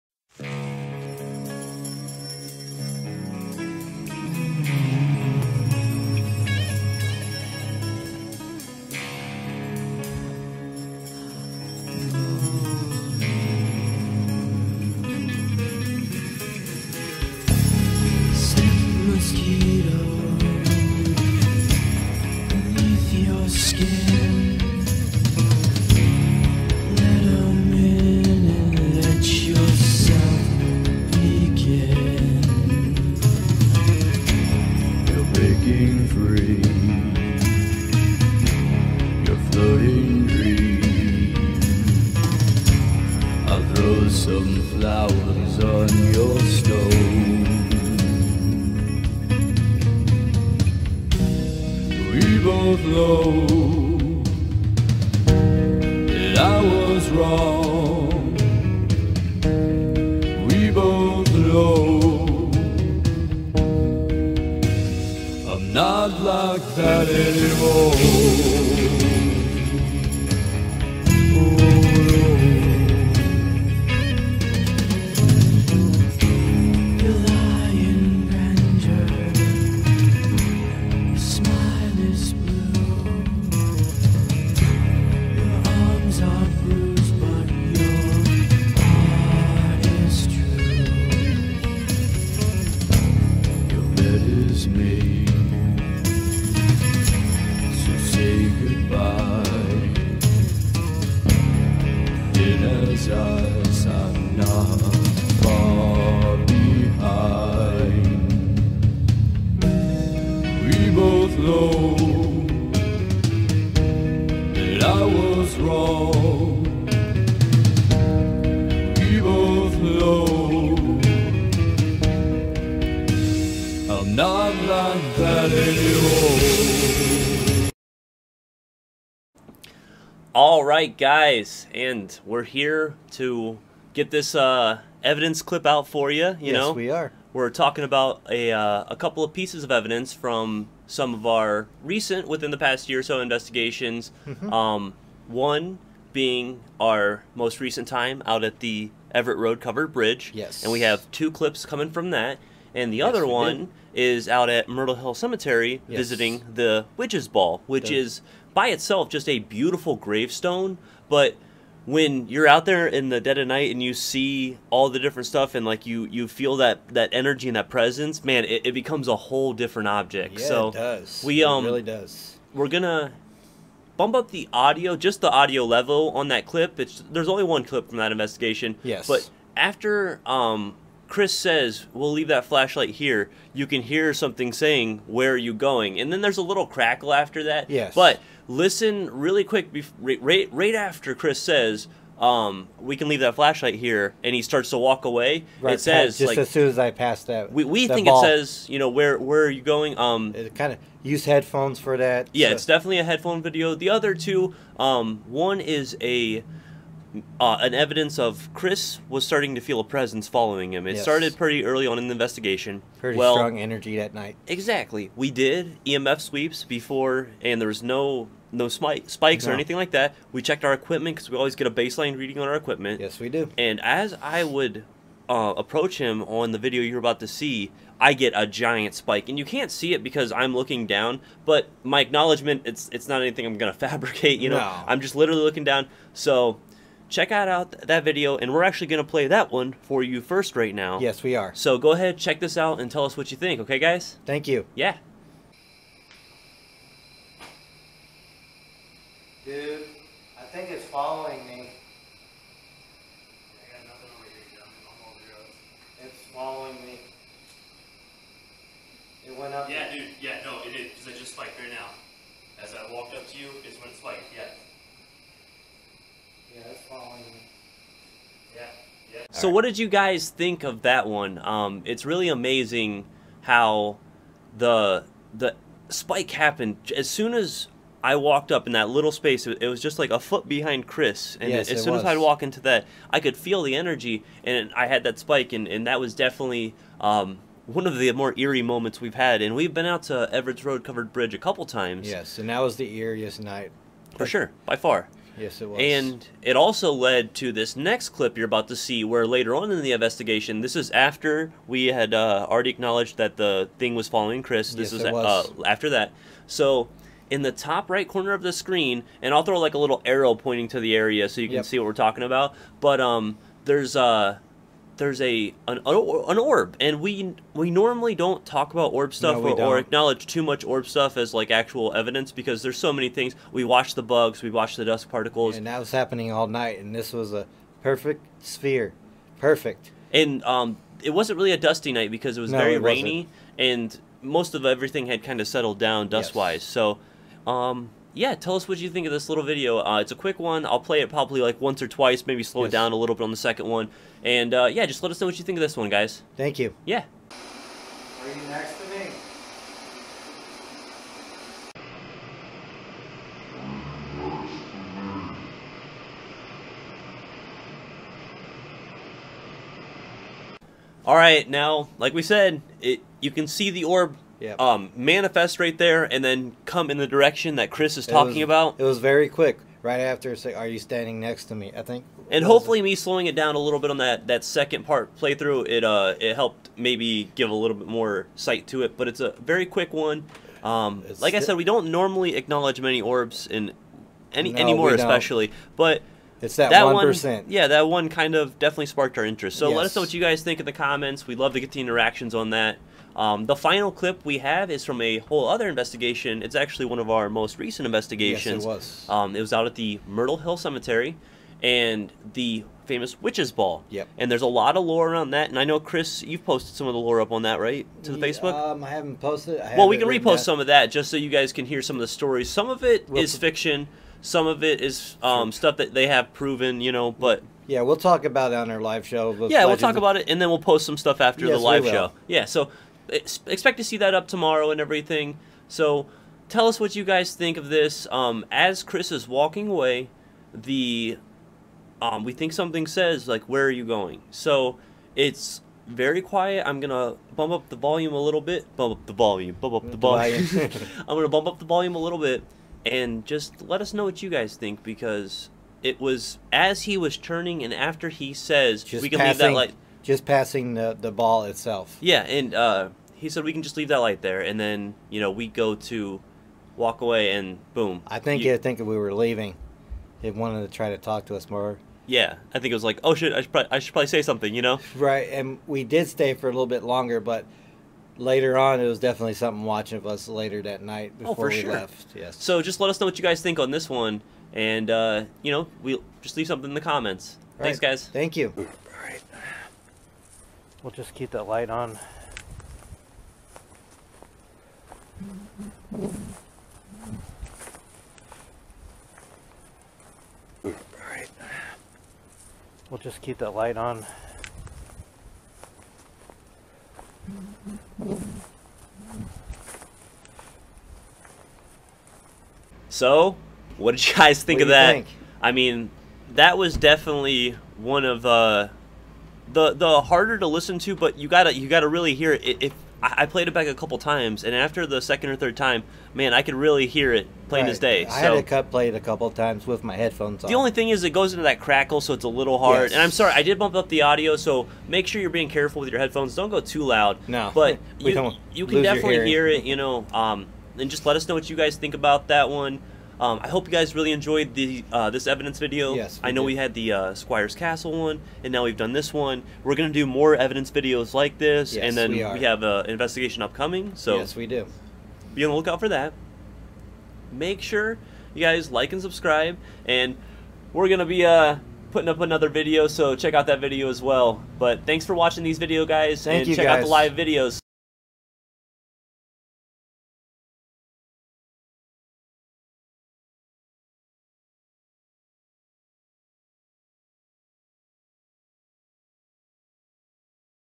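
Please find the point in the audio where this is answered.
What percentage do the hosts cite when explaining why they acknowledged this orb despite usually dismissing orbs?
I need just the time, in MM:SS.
06:26.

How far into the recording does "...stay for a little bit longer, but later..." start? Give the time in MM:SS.
07:46.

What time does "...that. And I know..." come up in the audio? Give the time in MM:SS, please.
06:45.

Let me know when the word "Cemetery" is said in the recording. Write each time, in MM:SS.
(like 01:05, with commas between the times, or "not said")
02:35, 06:40.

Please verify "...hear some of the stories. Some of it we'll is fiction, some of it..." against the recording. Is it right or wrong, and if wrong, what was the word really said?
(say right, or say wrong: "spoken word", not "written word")
right.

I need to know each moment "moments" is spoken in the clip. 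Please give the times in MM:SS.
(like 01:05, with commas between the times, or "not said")
04:48.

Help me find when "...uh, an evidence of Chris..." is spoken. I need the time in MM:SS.
03:27.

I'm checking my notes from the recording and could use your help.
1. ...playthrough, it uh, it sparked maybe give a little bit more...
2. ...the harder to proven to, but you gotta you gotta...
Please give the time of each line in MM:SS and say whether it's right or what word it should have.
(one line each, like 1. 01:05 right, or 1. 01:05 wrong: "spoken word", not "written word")
1. 06:15 wrong: "helped", not "sparked"
2. 08:29 wrong: "listen", not "proven".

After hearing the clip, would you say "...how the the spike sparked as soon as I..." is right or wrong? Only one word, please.
wrong.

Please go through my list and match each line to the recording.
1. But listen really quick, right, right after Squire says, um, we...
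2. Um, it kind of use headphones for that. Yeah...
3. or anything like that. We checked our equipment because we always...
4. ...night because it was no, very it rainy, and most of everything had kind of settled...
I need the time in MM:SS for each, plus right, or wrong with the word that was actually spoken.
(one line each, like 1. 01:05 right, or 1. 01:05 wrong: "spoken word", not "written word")
1. 03:07 wrong: "Chris", not "Squire"
2. 03:19 right
3. 03:39 right
4. 05:31 right.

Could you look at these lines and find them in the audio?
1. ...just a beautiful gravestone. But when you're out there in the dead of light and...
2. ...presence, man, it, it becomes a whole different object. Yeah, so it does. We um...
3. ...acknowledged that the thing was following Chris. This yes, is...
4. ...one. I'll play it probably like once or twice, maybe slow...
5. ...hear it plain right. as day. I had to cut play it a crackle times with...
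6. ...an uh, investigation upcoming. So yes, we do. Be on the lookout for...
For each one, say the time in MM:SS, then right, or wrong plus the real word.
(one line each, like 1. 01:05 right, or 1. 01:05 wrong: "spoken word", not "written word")
1. 02:39 wrong: "night", not "light"
2. 02:47 right
3. 05:02 right
4. 05:40 right
5. 08:36 wrong: "couple", not "crackle"
6. 09:02 right.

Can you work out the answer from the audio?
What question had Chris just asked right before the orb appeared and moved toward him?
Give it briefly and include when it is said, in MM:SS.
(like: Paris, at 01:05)
Are you next to me?, at 05:47.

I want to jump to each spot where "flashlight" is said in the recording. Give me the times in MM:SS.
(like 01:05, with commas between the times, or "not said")
03:02, 03:13.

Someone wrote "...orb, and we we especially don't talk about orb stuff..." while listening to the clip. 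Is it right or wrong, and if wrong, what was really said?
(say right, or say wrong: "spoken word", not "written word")
wrong: "normally", not "especially".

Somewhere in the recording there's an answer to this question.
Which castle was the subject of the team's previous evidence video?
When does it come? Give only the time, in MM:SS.
08:57.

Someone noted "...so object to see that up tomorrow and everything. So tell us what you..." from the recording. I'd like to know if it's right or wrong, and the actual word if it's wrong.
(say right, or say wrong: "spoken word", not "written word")
wrong: "expect", not "object".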